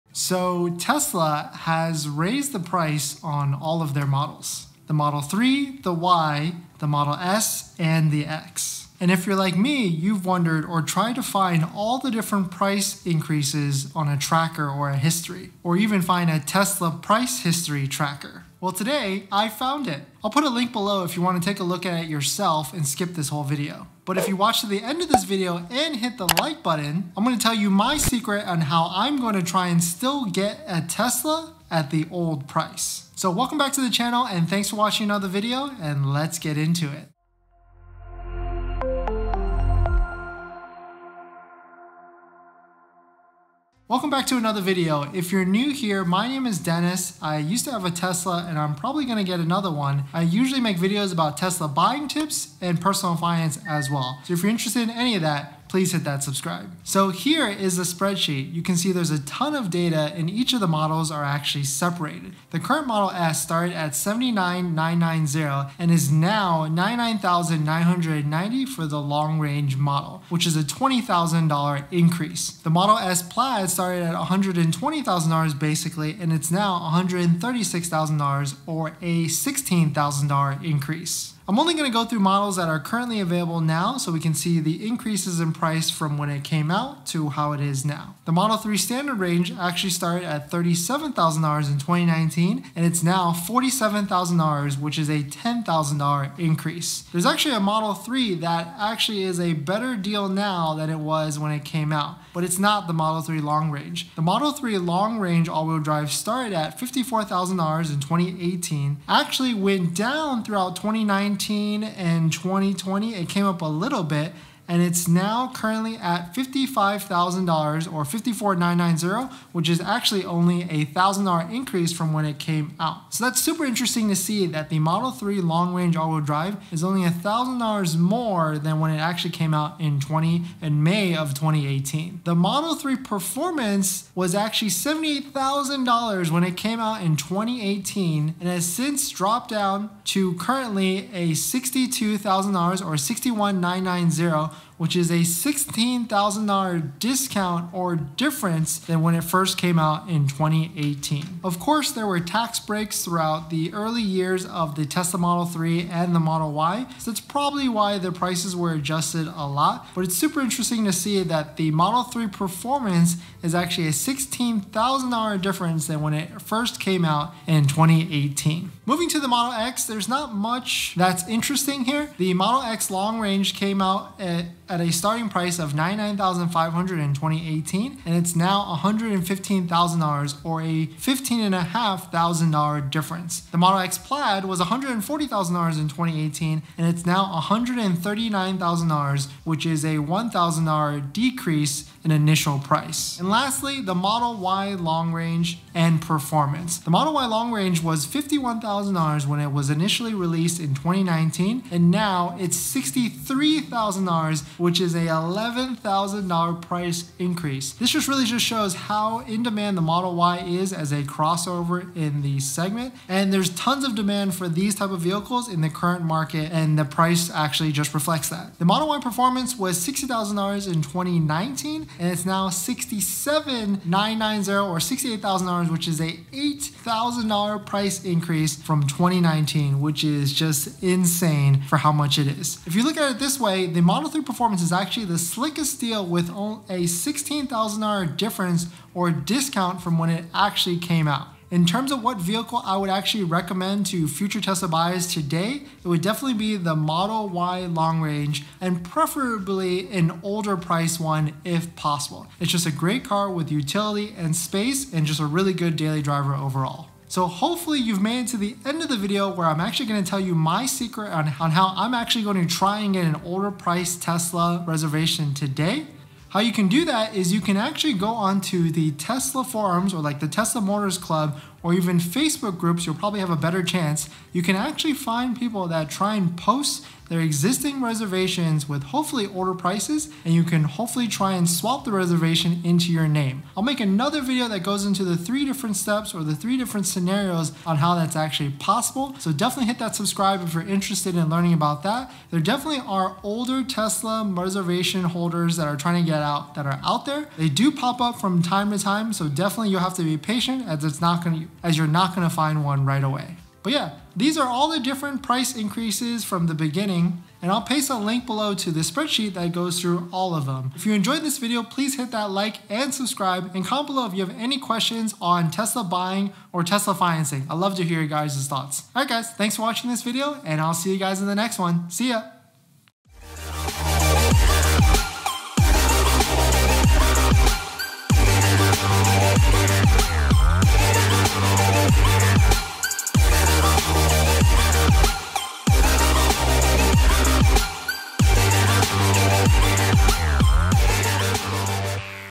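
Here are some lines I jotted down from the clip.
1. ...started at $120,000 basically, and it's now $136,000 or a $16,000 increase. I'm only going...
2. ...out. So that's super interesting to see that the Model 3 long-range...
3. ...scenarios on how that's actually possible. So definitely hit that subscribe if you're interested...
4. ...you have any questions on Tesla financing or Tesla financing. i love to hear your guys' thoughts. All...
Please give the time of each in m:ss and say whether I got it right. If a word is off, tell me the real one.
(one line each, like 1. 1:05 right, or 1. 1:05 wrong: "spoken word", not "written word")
1. 1:13 right
2. 2:02 right
3. 4:46 right
4. 5:14 wrong: "buying", not "financing".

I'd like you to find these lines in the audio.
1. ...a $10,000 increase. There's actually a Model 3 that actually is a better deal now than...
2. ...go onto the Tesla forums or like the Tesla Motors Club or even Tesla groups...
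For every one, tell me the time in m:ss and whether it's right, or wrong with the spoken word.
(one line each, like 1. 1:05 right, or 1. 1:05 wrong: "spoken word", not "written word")
1. 1:35 right
2. 4:27 wrong: "Facebook", not "Tesla".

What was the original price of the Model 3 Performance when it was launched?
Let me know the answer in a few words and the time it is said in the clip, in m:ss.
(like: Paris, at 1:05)
$78,000, at 2:14.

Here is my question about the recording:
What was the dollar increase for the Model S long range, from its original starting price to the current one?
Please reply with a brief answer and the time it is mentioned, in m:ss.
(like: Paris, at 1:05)
$20,000, at 1:10.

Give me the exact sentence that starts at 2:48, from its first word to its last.
Moving to the Model X, there's not much that's interesting here.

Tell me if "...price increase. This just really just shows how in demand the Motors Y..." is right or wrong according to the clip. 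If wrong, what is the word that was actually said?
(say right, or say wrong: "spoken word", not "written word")
wrong: "Model", not "Motors".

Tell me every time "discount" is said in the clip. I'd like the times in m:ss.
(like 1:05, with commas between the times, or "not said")
2:26, 3:59.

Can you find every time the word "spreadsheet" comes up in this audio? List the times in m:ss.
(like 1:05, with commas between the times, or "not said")
0:57, 5:08.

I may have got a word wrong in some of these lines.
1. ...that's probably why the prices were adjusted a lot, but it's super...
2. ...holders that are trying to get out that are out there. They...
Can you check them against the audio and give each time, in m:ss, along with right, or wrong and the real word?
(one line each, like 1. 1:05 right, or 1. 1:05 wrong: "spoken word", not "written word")
1. 2:37 right
2. 4:55 right.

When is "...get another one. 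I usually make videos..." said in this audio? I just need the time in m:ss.
0:49.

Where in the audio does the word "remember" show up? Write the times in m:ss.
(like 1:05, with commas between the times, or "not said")
not said.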